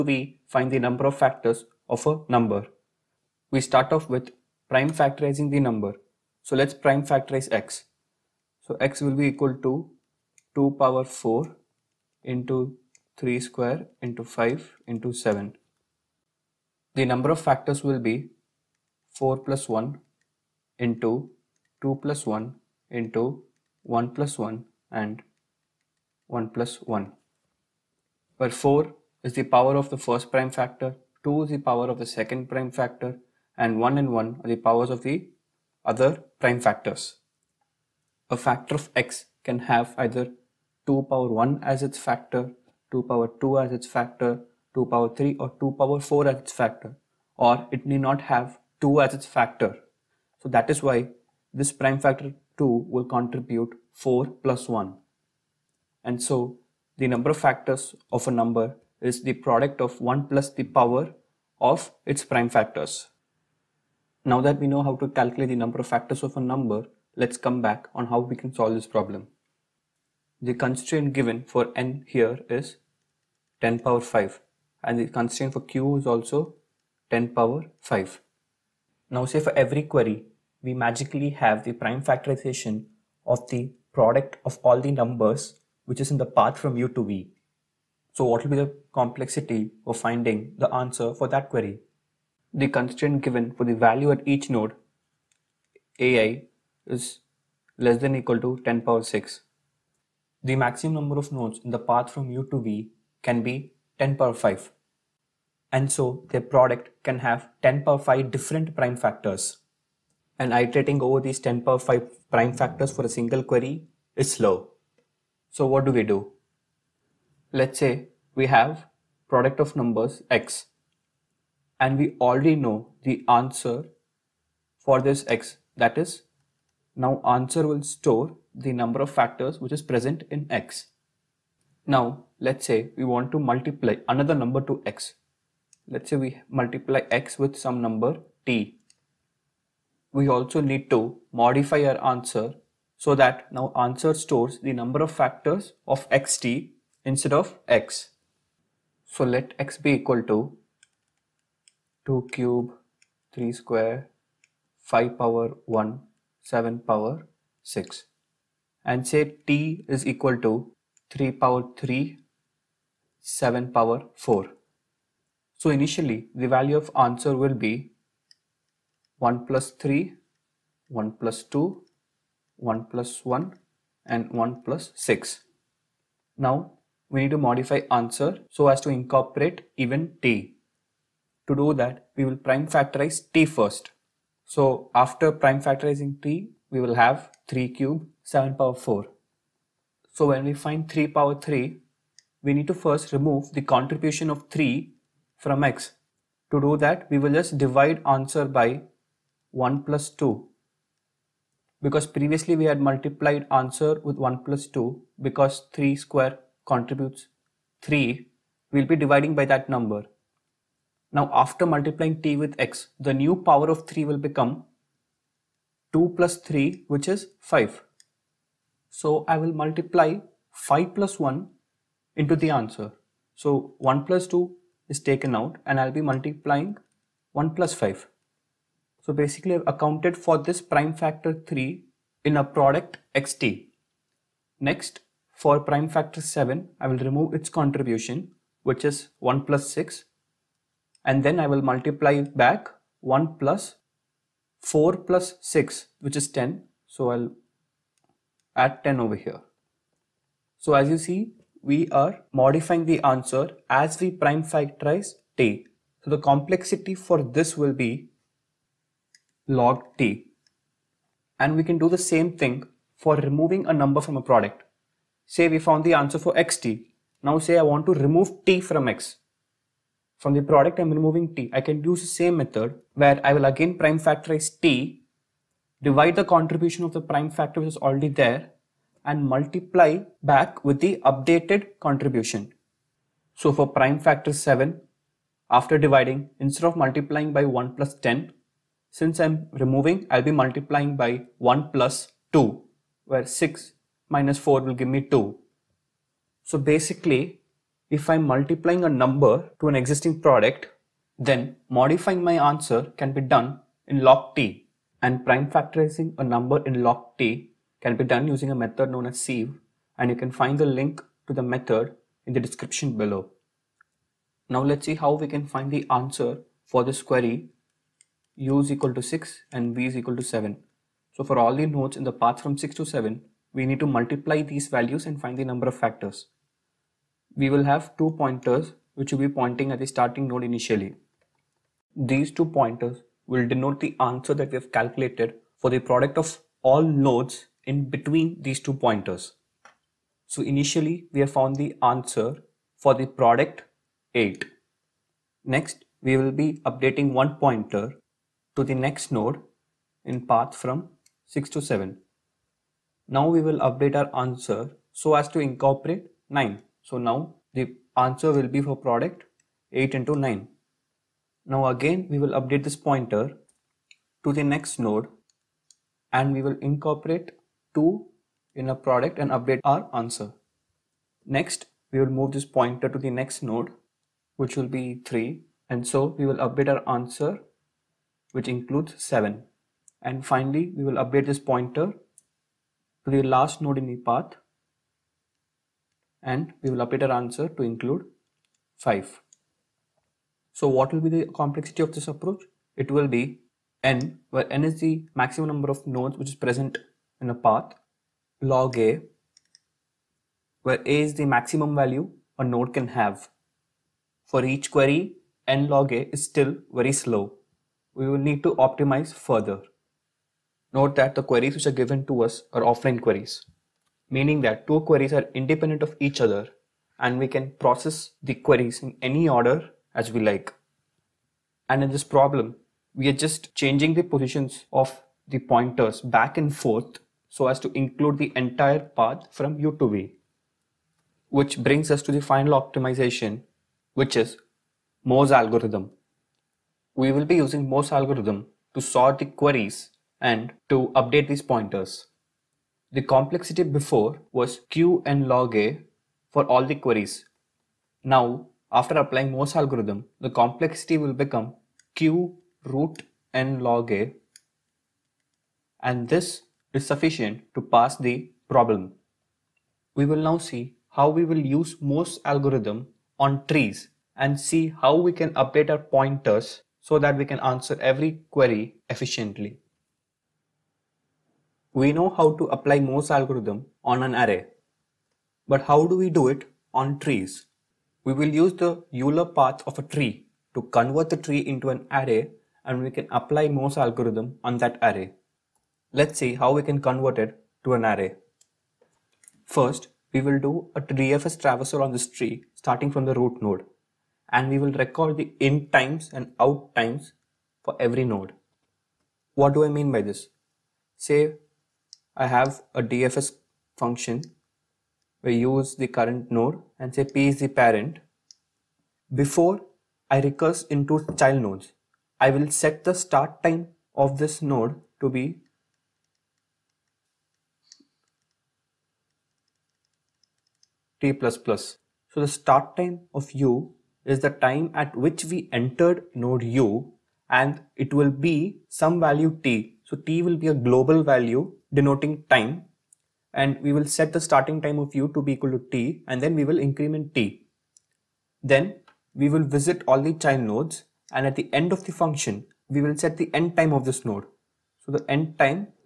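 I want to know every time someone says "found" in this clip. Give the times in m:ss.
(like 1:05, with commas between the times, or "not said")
4:25, 5:41.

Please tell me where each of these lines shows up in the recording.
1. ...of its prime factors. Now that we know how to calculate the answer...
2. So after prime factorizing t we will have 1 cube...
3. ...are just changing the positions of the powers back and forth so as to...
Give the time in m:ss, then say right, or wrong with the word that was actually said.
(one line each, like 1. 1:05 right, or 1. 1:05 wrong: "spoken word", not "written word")
1. 1:01 wrong: "number", not "answer"
2. 3:04 wrong: "3", not "1"
3. 7:03 wrong: "pointers", not "powers".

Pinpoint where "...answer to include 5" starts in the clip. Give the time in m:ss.
6:27.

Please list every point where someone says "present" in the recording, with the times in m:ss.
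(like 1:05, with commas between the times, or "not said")
2:09, 6:36.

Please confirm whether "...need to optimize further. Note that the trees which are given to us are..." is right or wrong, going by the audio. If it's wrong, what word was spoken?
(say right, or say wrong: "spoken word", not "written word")
wrong: "queries", not "trees".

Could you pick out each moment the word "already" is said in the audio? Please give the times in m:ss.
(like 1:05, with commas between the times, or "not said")
2:02, 4:37.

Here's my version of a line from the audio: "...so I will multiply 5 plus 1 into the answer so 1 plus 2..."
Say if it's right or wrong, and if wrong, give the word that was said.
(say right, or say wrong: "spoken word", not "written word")
right.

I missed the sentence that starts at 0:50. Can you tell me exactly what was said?
So that is why this prime factor 2 will contribute 4 plus 1.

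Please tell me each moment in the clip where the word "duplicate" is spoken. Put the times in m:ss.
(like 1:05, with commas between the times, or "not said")
not said.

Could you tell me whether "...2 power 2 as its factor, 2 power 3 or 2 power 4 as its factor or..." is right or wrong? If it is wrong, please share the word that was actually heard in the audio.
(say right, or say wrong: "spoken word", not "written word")
right.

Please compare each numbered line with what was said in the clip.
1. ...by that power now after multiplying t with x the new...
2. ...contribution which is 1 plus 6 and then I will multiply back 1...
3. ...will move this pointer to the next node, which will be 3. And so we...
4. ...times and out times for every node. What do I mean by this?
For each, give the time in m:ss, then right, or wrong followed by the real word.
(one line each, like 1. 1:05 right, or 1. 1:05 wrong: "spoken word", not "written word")
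1. 3:29 wrong: "number", not "power"
2. 3:57 right
3. 6:11 right
4. 8:15 right.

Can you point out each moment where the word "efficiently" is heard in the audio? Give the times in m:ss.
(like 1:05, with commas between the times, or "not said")
7:48.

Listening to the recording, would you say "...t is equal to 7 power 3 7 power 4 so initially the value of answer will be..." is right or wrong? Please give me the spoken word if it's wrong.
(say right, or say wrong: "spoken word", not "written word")
wrong: "3", not "7".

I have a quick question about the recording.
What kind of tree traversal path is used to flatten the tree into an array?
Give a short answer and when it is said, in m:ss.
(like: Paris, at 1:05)
Euler path, at 7:58.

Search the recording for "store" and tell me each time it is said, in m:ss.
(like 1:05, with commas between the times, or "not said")
2:07, 2:24.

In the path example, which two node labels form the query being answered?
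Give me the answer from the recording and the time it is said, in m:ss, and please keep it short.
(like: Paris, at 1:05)
6 and 7, at 5:18.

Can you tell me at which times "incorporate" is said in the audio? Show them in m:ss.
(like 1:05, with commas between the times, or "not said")
2:58, 5:55, 6:06.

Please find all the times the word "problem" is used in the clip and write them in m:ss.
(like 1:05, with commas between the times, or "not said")
1:08, 7:02, 7:38.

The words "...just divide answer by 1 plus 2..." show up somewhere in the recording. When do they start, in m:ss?
3:17.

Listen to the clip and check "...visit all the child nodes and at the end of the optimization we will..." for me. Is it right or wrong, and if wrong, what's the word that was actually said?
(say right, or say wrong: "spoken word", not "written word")
wrong: "function", not "optimization".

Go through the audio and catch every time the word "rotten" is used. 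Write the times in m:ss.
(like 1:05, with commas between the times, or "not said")
not said.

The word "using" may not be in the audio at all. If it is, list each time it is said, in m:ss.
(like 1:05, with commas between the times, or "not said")
5:08, 7:17.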